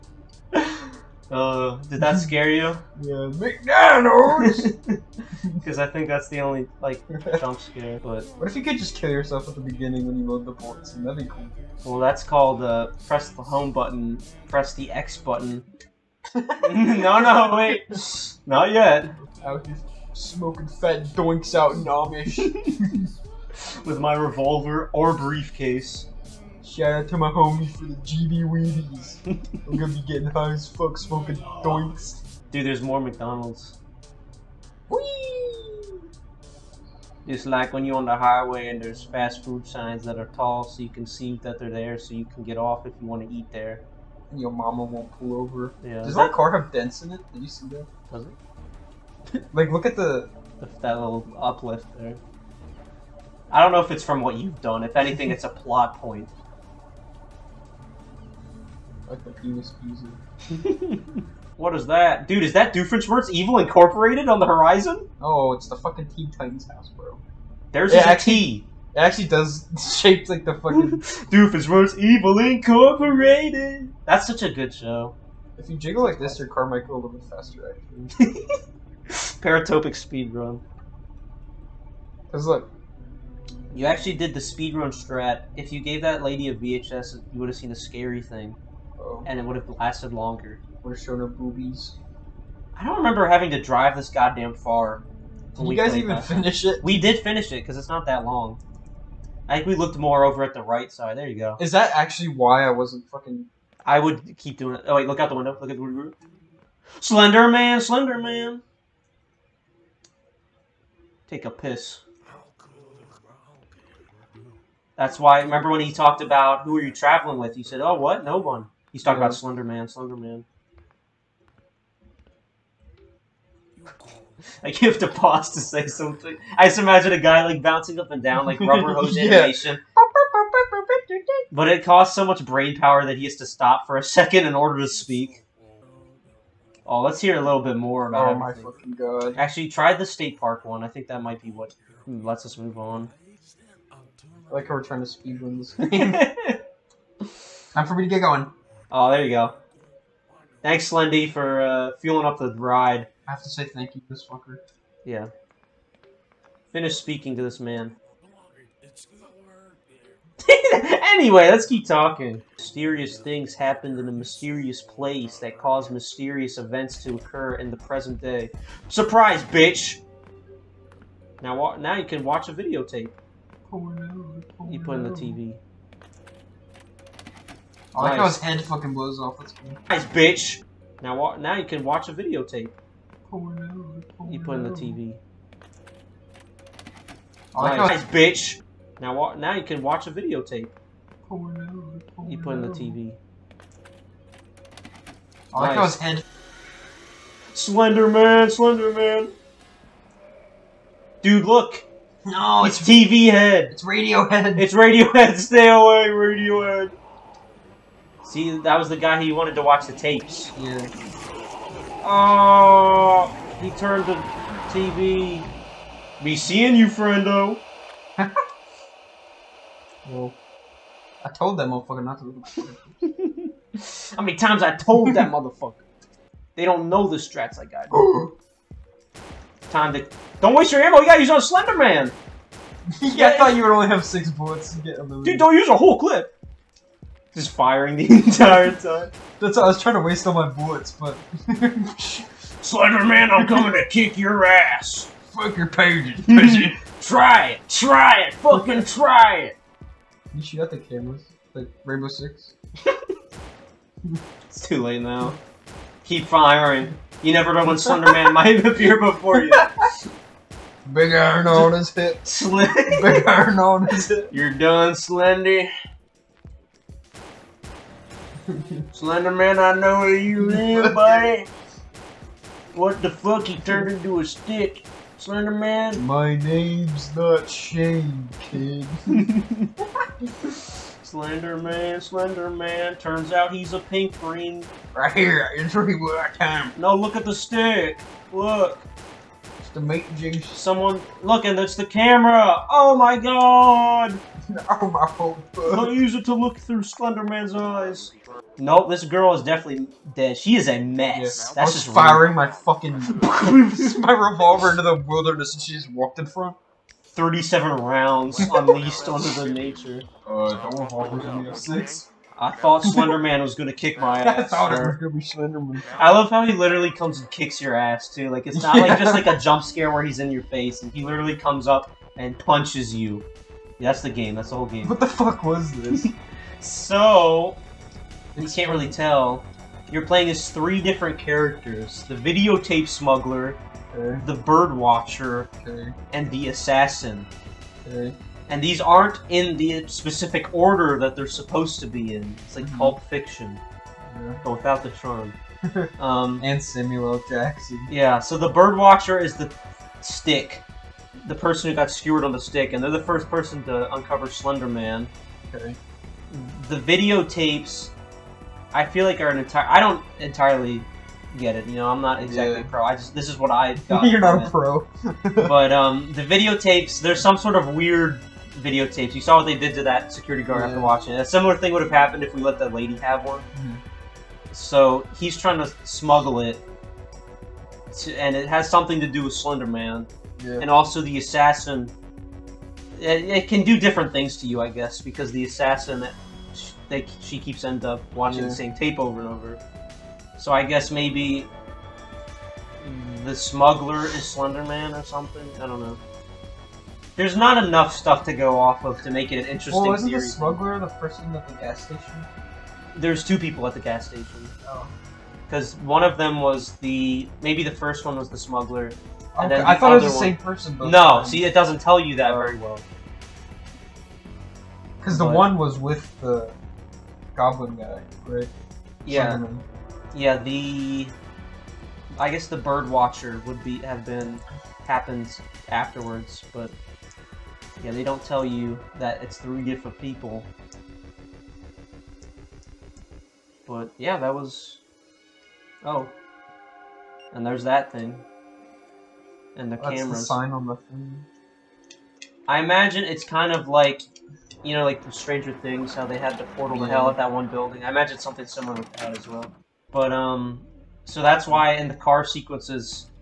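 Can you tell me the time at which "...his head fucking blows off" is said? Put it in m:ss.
2:58.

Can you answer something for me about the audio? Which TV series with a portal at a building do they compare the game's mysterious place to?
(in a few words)
Stranger Things.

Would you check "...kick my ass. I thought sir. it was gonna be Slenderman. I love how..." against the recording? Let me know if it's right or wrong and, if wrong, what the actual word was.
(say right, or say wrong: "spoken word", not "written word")
right.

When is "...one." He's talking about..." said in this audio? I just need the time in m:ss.
1:58.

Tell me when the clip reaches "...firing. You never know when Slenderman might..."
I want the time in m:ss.
4:16.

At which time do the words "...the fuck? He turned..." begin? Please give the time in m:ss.
4:33.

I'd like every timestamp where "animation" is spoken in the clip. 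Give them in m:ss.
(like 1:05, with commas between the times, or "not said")
2:09.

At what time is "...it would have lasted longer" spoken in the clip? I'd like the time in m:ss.
1:29.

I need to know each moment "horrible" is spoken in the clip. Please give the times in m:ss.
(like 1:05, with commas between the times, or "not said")
not said.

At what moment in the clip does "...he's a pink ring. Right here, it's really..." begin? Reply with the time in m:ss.
4:43.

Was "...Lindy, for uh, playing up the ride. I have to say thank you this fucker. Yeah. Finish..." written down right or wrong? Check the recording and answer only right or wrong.
wrong.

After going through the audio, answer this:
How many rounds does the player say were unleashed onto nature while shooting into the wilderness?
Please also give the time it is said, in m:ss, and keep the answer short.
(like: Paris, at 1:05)
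37, at 5:07.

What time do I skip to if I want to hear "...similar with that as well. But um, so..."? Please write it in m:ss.
7:28.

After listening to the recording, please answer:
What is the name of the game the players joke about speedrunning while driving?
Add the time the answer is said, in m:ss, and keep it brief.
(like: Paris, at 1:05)
Paratopic, at 1:19.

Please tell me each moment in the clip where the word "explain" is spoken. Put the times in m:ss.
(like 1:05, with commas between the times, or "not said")
not said.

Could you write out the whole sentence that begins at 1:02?
Dude, is that Doofenshmirtz Evil Incorporated on the horizon?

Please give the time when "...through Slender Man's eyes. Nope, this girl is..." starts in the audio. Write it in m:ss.
4:56.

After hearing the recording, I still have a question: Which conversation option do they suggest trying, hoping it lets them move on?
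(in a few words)
the state park one.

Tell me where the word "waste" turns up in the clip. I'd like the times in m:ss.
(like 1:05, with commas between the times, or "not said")
3:50, 4:00.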